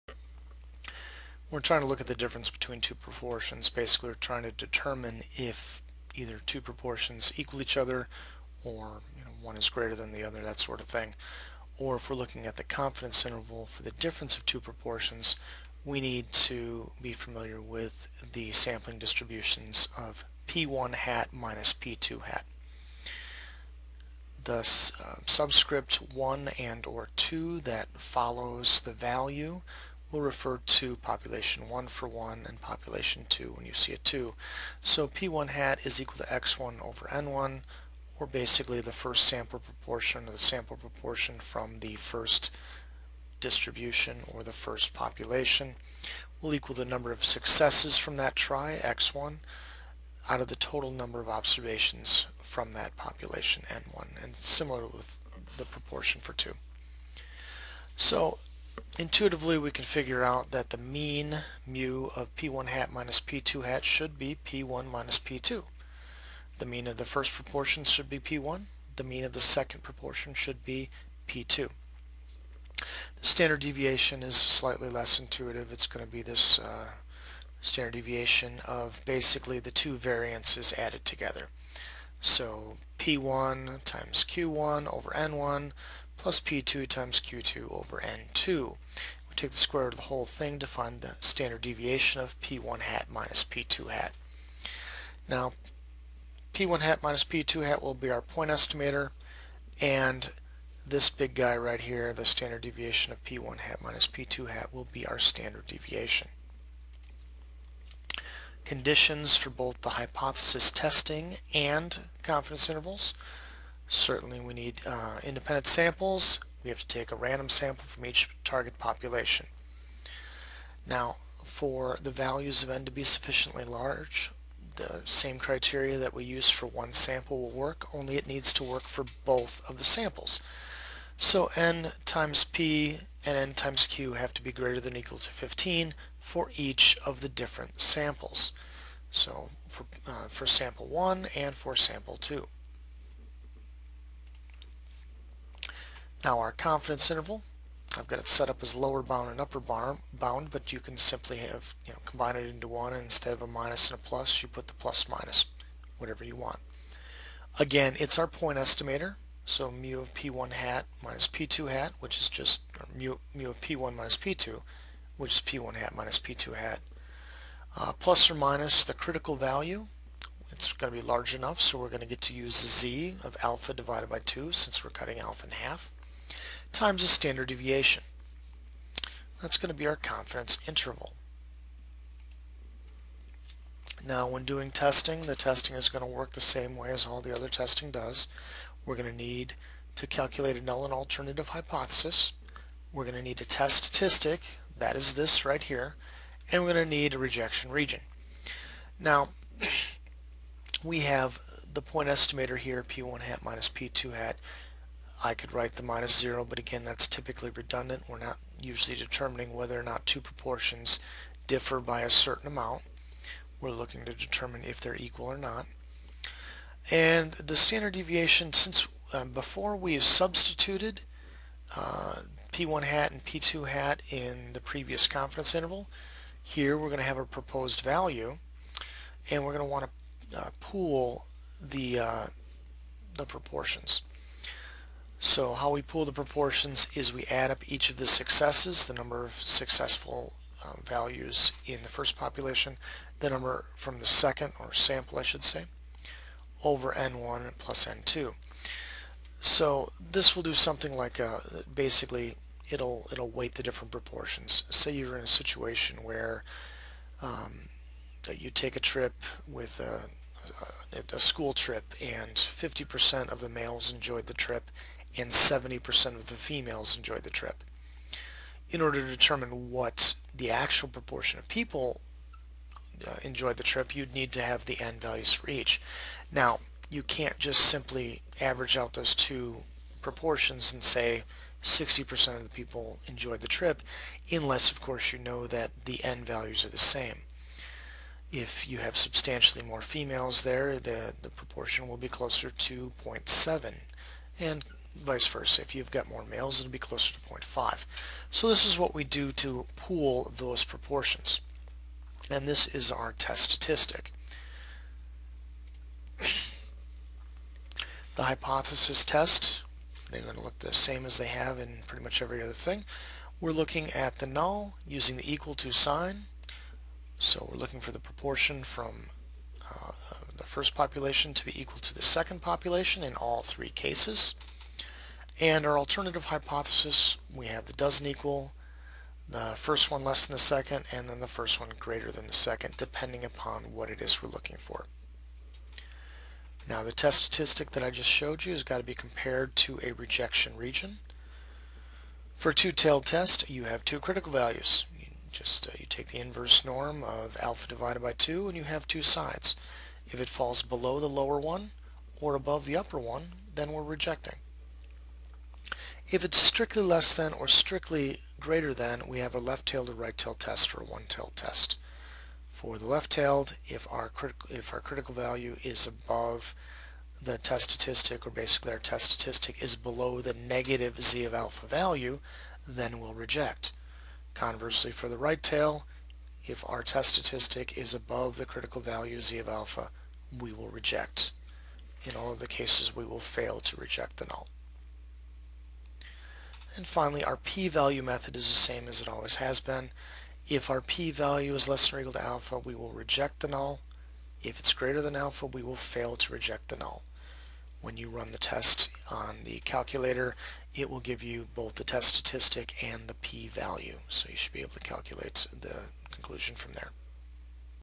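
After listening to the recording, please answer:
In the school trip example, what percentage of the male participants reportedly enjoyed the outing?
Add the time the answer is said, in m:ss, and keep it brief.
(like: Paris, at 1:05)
50%, at 4:22.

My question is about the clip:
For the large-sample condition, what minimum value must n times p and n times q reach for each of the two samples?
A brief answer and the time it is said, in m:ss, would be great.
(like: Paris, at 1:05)
15, at 2:15.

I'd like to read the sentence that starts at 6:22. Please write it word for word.
In all of the cases, we will fail to reject the null.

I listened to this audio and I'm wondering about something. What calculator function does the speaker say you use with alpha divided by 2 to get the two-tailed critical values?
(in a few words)
inverse norm.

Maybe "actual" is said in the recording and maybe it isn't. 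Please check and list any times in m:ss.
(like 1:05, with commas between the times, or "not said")
4:30.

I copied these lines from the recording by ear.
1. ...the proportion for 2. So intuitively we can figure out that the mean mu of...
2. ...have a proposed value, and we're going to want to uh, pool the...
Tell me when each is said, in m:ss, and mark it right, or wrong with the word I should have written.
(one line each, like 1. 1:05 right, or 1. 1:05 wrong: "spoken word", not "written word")
1. 0:55 right
2. 3:47 right.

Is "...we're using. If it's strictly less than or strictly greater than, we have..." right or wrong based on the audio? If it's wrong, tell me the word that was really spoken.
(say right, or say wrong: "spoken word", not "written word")
wrong: "rejecting", not "using".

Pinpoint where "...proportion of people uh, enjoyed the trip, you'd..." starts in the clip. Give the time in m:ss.
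4:30.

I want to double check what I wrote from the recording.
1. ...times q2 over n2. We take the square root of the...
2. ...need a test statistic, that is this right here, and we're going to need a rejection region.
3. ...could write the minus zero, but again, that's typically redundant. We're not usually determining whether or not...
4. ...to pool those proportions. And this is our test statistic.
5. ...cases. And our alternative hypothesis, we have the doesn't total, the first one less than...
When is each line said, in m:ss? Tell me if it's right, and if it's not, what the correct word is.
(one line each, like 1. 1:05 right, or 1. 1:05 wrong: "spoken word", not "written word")
1. 1:26 right
2. 3:13 right
3. 3:25 right
4. 4:59 right
5. 5:23 wrong: "equal", not "total".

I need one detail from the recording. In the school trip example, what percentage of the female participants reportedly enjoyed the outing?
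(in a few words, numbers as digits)
70%.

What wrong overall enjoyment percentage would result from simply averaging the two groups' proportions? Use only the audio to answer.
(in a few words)
60%.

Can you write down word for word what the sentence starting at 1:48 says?
Conditions for both the hypothesis testing and confidence intervals.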